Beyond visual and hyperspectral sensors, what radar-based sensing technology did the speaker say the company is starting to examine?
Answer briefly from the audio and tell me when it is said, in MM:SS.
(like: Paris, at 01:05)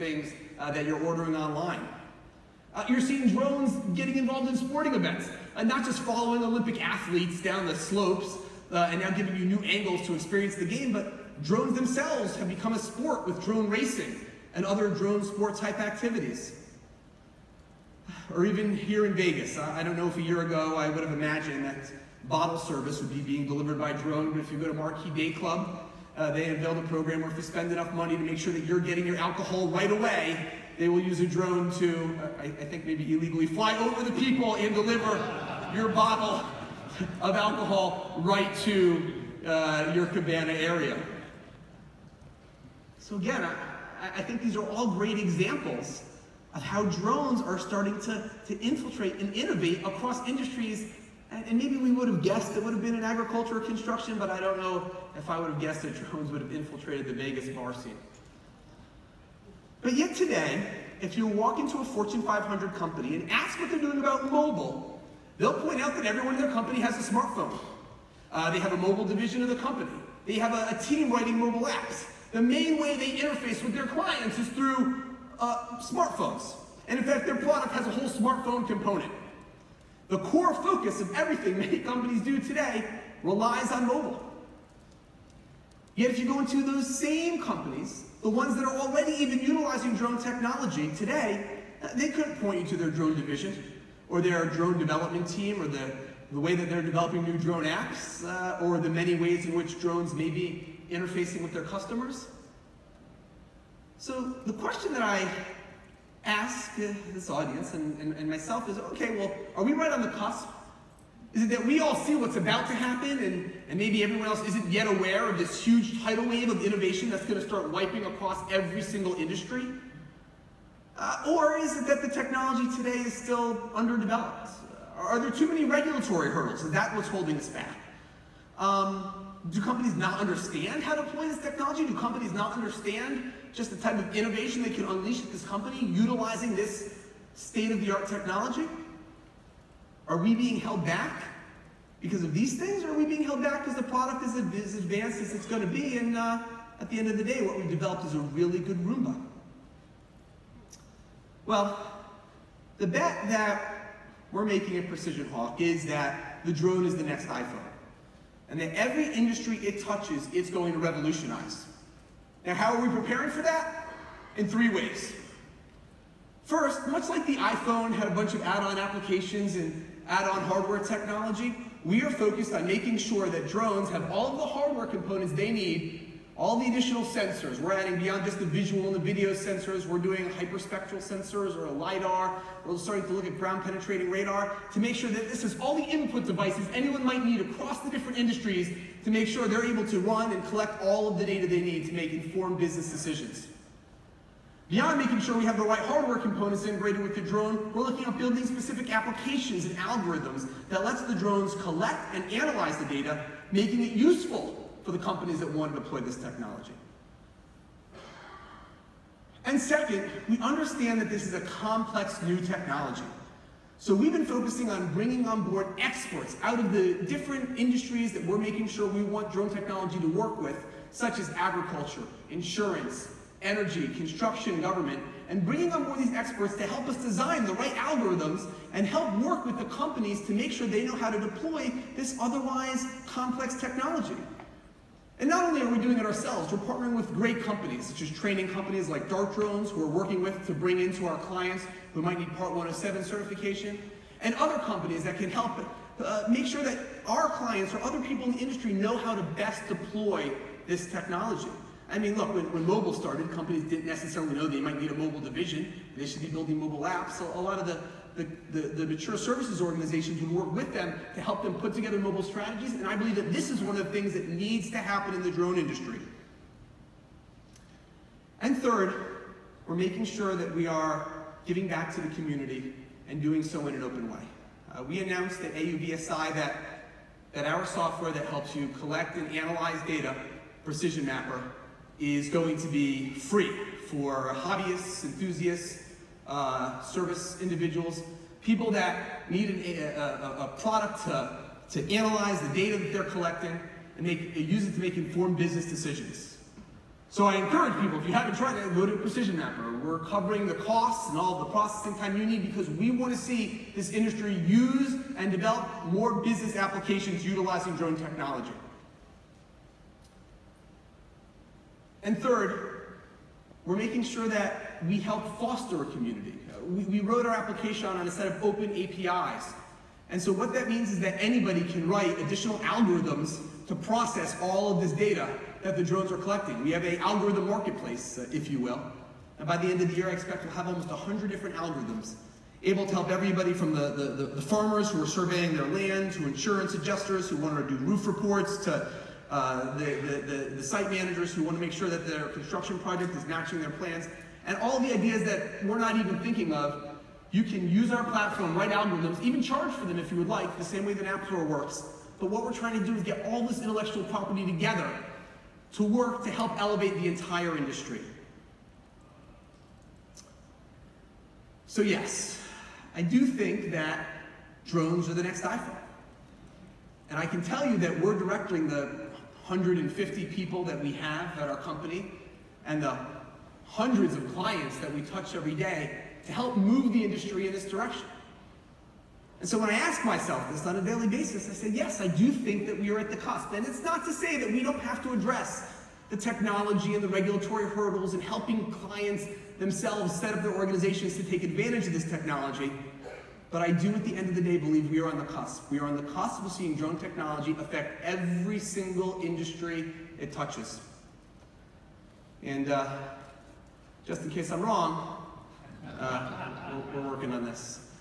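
ground penetrating radar, at 03:03.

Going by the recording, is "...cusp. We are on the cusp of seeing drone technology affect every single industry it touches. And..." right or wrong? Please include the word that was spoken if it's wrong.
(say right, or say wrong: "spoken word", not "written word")
right.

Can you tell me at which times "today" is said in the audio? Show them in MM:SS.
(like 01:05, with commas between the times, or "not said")
01:00, 01:22, 01:30, 02:02.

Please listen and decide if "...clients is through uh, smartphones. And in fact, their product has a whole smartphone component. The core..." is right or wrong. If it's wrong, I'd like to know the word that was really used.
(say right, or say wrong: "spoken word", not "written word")
right.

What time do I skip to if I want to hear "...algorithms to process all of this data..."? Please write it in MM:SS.
05:22.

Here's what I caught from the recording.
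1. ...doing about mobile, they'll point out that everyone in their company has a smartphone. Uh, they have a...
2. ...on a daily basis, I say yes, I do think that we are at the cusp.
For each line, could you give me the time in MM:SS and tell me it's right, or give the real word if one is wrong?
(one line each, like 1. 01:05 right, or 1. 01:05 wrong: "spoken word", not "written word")
1. 01:03 right
2. 06:20 right.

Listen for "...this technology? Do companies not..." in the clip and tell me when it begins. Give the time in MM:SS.
02:11.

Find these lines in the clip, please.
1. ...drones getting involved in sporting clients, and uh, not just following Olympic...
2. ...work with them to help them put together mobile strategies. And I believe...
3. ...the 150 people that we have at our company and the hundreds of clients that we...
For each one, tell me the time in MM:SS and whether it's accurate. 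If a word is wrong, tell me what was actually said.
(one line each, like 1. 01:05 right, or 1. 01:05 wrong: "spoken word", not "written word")
1. 00:03 wrong: "events", not "clients"
2. 04:20 right
3. 06:08 right.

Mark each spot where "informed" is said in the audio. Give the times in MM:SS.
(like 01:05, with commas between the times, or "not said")
03:12, 04:54.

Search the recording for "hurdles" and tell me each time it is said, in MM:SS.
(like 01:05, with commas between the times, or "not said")
02:06, 06:27.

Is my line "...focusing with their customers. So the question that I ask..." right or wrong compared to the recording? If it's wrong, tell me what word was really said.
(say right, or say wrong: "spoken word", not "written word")
wrong: "interfacing", not "focusing".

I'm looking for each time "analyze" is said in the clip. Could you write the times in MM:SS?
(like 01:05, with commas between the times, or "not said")
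03:22, 04:39, 04:51.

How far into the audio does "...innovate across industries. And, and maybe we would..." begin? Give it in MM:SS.
00:49.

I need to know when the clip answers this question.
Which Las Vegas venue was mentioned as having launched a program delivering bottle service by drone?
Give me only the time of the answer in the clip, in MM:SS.
00:24.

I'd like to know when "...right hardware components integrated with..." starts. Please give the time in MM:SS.
03:15.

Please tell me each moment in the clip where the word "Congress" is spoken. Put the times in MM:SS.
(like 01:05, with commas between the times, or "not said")
not said.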